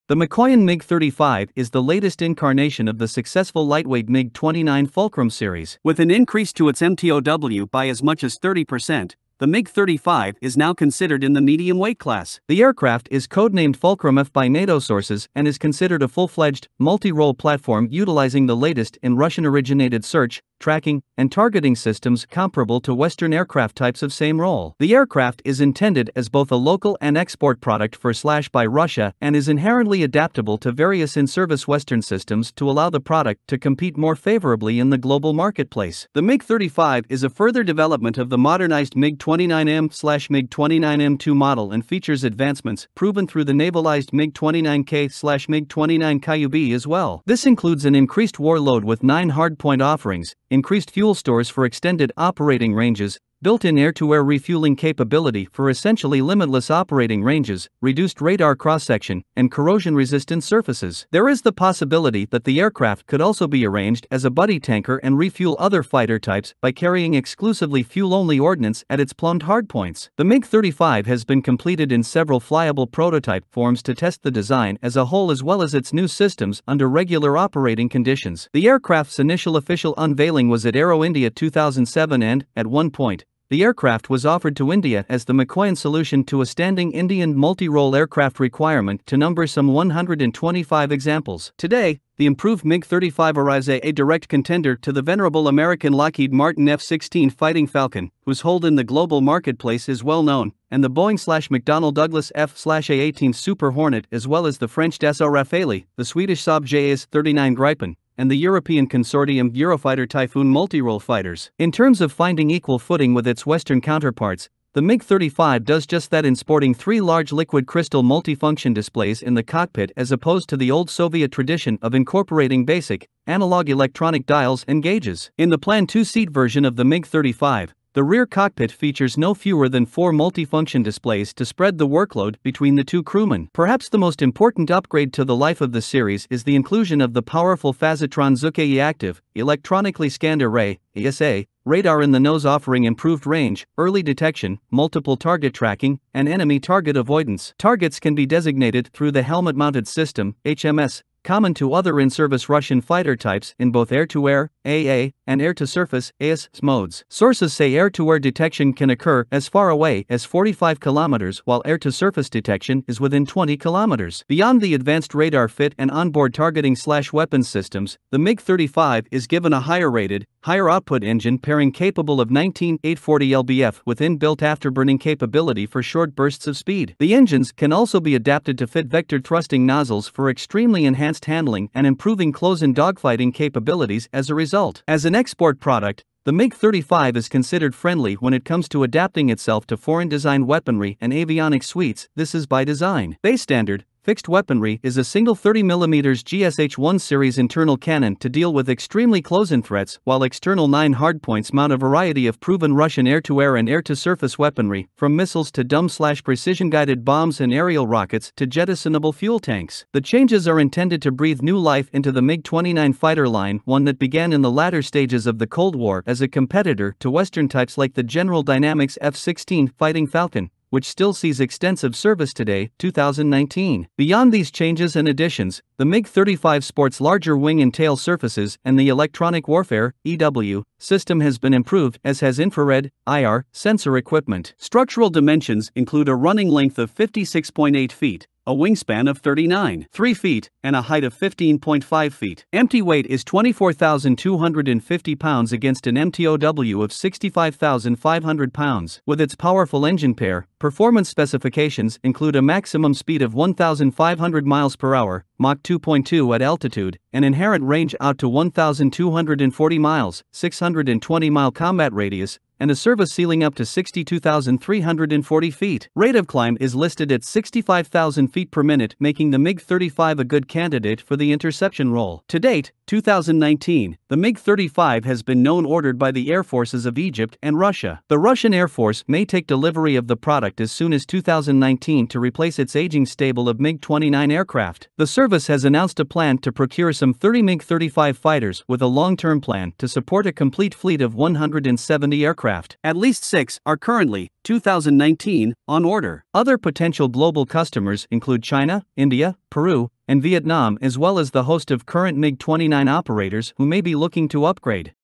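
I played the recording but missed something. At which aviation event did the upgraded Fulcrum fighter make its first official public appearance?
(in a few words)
Aero India 2007.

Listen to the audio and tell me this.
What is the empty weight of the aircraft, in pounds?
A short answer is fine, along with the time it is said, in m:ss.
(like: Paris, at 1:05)
24,250 pounds, at 4:03.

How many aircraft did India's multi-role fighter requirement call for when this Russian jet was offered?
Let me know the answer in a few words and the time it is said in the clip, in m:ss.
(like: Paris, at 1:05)
125, at 1:29.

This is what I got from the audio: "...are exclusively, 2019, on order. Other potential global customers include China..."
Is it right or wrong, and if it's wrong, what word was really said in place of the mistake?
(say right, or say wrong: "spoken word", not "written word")
wrong: "currently", not "exclusively".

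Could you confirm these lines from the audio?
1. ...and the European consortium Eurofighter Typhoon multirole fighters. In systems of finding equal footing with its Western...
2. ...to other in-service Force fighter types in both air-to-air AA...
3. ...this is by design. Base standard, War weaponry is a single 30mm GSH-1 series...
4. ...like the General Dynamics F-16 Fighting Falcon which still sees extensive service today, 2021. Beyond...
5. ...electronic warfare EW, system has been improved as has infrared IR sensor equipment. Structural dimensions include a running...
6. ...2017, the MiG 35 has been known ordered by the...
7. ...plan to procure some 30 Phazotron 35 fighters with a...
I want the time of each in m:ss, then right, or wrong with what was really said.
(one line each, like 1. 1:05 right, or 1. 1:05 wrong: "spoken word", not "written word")
1. 1:48 wrong: "terms", not "systems"
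2. 2:31 wrong: "Russian", not "Force"
3. 3:12 wrong: "Fixed", not "War"
4. 3:37 wrong: "2019", not "2021"
5. 3:48 right
6. 4:32 wrong: "2019", not "2017"
7. 4:46 wrong: "MiG", not "Phazotron".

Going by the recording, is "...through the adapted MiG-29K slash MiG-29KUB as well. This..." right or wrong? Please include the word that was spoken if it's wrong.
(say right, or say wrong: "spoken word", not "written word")
wrong: "navalized", not "adapted".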